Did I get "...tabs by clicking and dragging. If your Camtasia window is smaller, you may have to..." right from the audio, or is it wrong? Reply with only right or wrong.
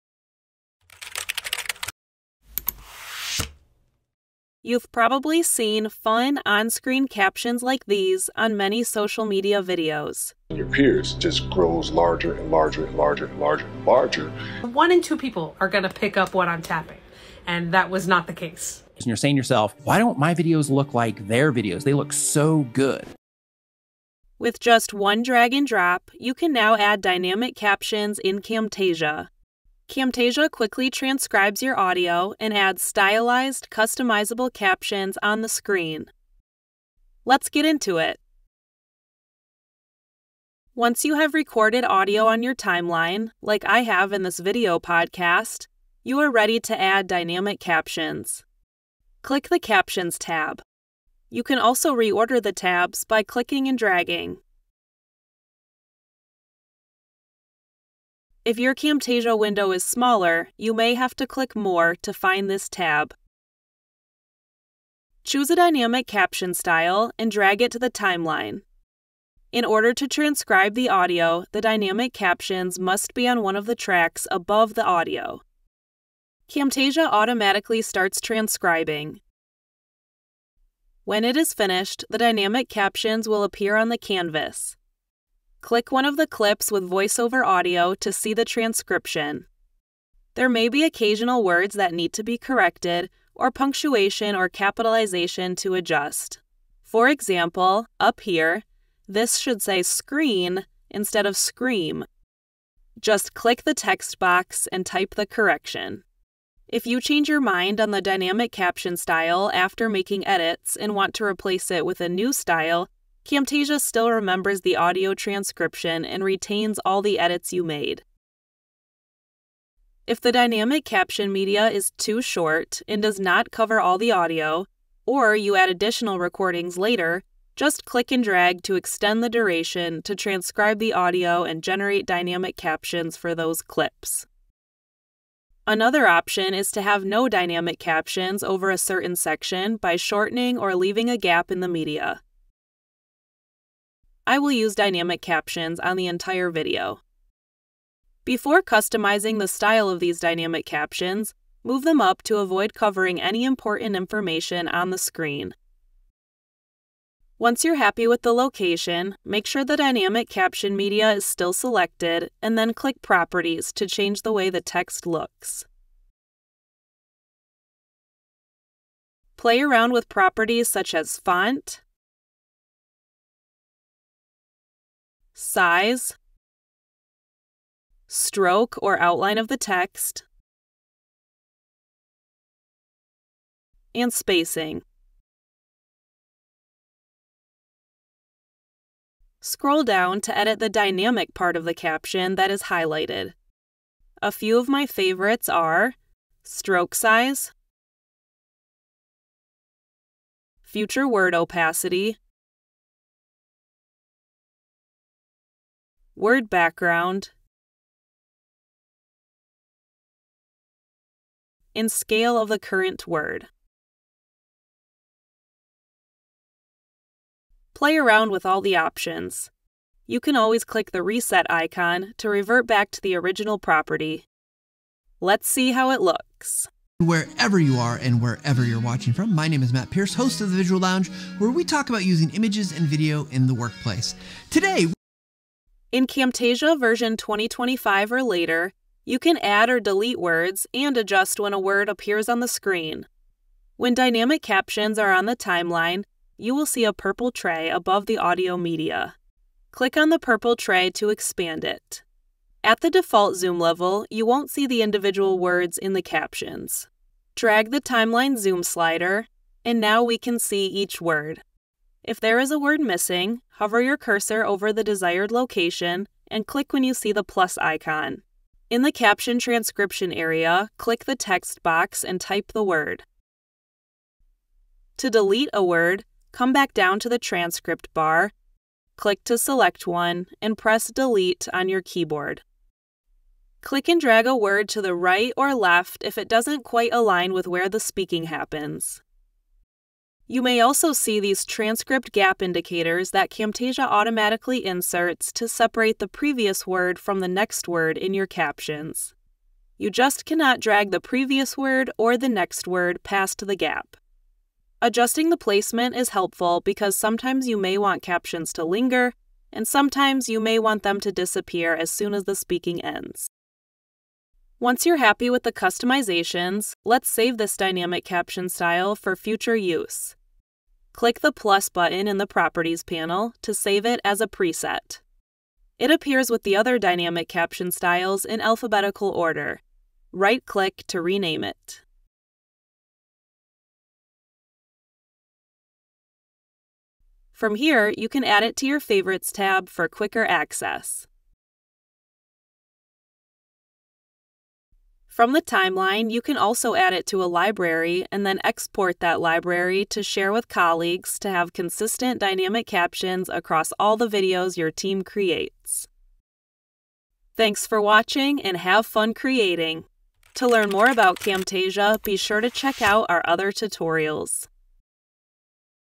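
right.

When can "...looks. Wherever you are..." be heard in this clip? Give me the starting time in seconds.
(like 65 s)
226 s.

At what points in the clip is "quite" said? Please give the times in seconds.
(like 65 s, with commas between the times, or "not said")
286 s.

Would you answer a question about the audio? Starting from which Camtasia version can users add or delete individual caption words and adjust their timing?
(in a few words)
2025.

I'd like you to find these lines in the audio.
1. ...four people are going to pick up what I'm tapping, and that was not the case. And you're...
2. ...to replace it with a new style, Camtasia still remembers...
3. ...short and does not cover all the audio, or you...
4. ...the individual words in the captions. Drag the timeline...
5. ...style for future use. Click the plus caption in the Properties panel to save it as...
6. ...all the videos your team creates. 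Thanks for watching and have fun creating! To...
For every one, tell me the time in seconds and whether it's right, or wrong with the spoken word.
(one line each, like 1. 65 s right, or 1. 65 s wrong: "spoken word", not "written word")
1. 15 s wrong: "two", not "four"
2. 111 s right
3. 122 s right
4. 254 s right
5. 318 s wrong: "button", not "caption"
6. 353 s right.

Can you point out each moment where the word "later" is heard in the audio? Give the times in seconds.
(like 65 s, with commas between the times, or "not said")
126 s, 238 s.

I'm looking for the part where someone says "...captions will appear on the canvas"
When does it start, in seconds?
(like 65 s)
82 s.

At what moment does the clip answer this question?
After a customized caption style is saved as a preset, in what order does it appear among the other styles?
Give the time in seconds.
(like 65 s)
328 s.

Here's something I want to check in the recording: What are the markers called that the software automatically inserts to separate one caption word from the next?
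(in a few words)
transcript gap indicators.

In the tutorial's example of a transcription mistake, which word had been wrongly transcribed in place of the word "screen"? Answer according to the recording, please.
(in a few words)
scream.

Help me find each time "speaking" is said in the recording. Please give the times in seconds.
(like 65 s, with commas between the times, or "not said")
287 s, 312 s.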